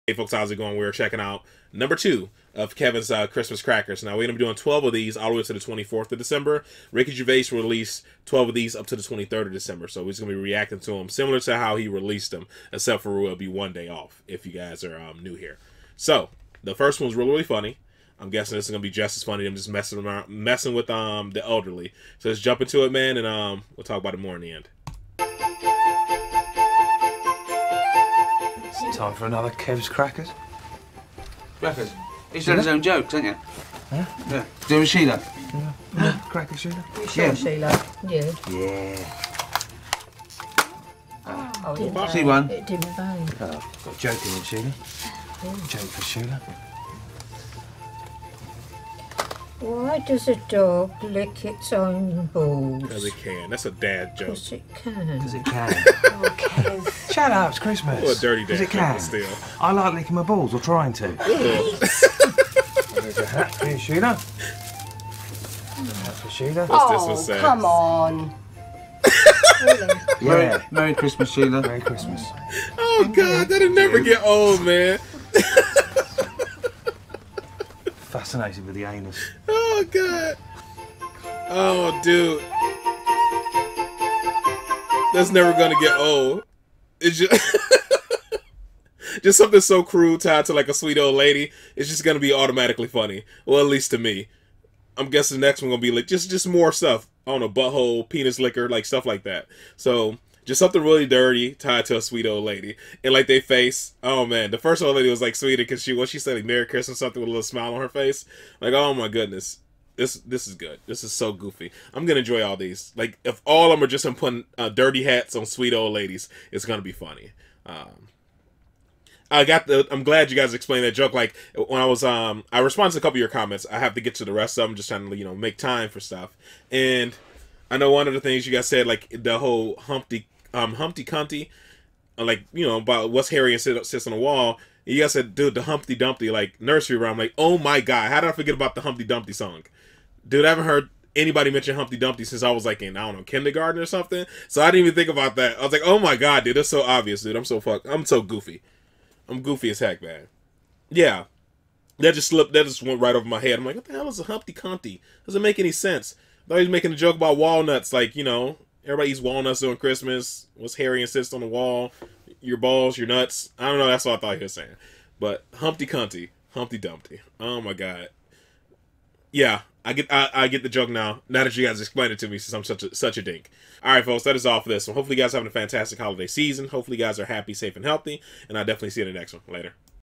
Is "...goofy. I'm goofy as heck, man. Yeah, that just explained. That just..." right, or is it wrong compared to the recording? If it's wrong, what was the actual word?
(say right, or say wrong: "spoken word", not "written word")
wrong: "slipped", not "explained".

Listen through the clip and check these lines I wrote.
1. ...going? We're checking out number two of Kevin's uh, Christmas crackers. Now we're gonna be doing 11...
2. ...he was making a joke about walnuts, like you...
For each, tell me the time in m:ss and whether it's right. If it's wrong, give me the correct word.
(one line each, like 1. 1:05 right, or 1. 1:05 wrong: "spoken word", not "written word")
1. 0:00 wrong: "12", not "11"
2. 2:36 right.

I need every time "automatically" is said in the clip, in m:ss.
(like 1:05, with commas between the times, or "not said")
1:32.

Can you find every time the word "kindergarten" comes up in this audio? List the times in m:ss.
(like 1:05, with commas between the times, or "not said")
2:23.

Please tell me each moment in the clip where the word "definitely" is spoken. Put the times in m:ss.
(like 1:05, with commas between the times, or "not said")
2:58.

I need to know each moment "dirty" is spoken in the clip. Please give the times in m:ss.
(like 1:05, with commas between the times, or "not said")
0:58, 1:41, 1:54.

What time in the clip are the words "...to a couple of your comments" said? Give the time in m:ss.
2:02.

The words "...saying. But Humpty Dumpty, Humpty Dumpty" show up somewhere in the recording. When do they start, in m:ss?
2:44.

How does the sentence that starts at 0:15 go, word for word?
So the first one's really, really funny.